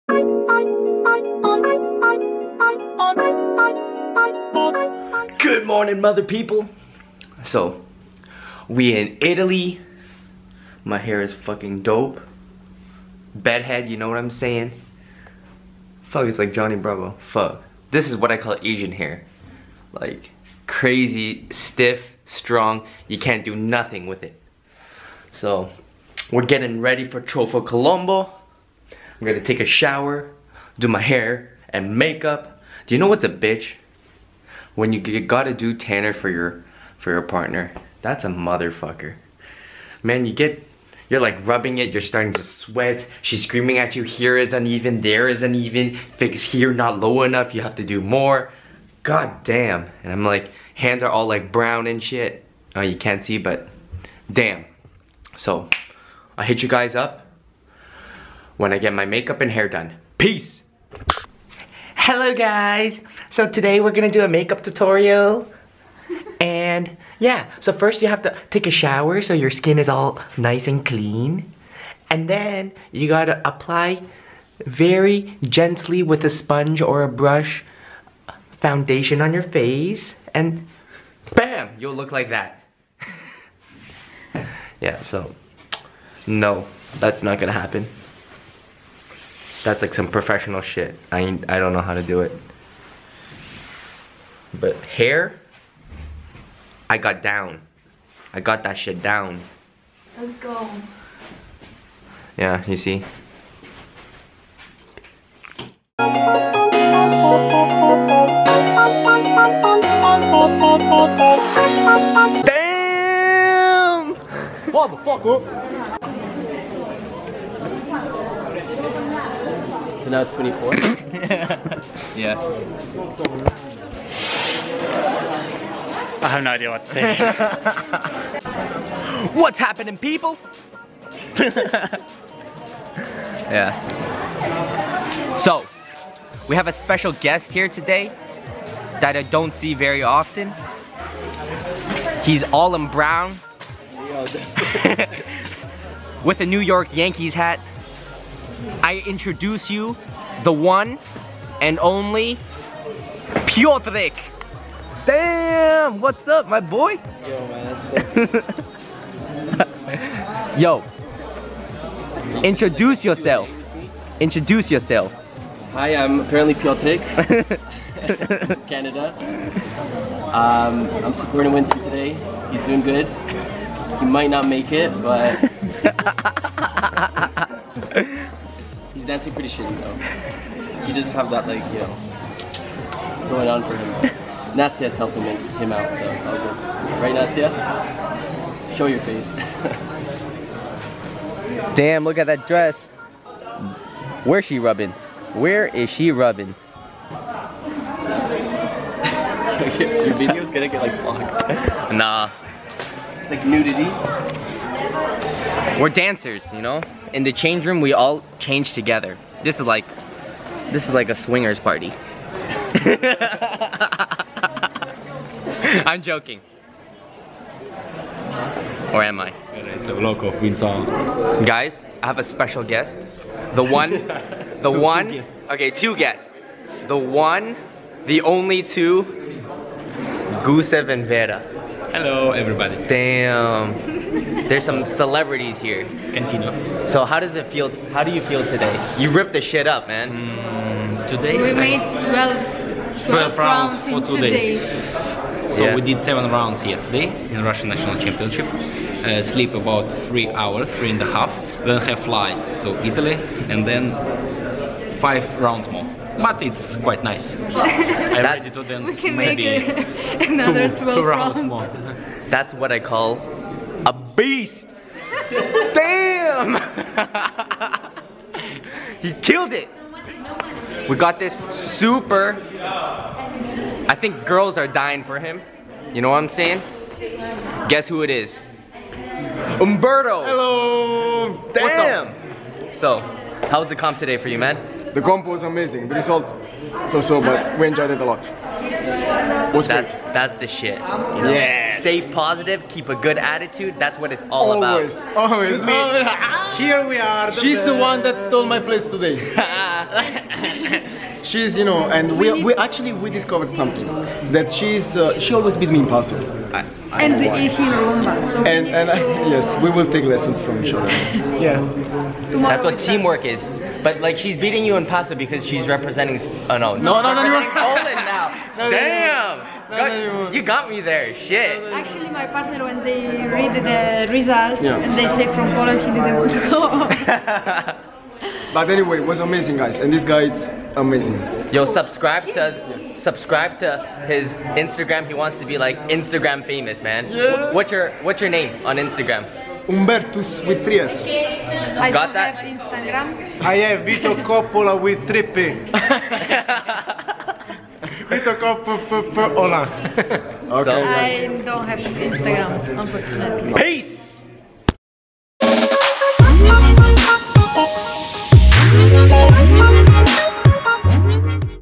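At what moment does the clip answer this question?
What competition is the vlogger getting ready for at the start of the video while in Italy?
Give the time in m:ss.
0:27.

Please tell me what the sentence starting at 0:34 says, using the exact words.
When you gotta do tanner for your for your partner.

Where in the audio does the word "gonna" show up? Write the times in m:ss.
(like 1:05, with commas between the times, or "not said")
0:29, 1:03, 1:27, 3:20.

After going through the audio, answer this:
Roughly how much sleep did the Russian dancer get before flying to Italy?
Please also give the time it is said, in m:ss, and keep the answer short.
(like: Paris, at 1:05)
3 and a half, at 4:10.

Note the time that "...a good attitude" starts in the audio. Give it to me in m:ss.
4:52.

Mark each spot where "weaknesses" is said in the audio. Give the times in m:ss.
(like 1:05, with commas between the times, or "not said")
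not said.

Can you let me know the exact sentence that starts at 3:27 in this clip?
In the change room, we all change together.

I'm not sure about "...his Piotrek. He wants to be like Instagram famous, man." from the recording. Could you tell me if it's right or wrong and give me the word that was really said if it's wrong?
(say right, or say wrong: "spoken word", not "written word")
wrong: "Instagram", not "Piotrek".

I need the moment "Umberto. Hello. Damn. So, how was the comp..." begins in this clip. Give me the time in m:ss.
4:39.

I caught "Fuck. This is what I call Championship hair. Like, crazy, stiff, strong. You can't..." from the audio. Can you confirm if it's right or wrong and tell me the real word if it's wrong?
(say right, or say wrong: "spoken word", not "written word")
wrong: "Asian", not "Championship".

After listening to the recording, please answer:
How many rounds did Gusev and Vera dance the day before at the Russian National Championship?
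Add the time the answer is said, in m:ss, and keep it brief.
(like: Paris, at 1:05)
7, at 4:06.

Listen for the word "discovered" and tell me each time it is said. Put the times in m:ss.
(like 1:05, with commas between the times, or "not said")
5:03.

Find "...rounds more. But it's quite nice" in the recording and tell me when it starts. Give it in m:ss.
4:15.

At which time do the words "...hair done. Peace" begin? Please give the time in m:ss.
0:59.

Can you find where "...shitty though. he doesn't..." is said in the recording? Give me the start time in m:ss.
2:59.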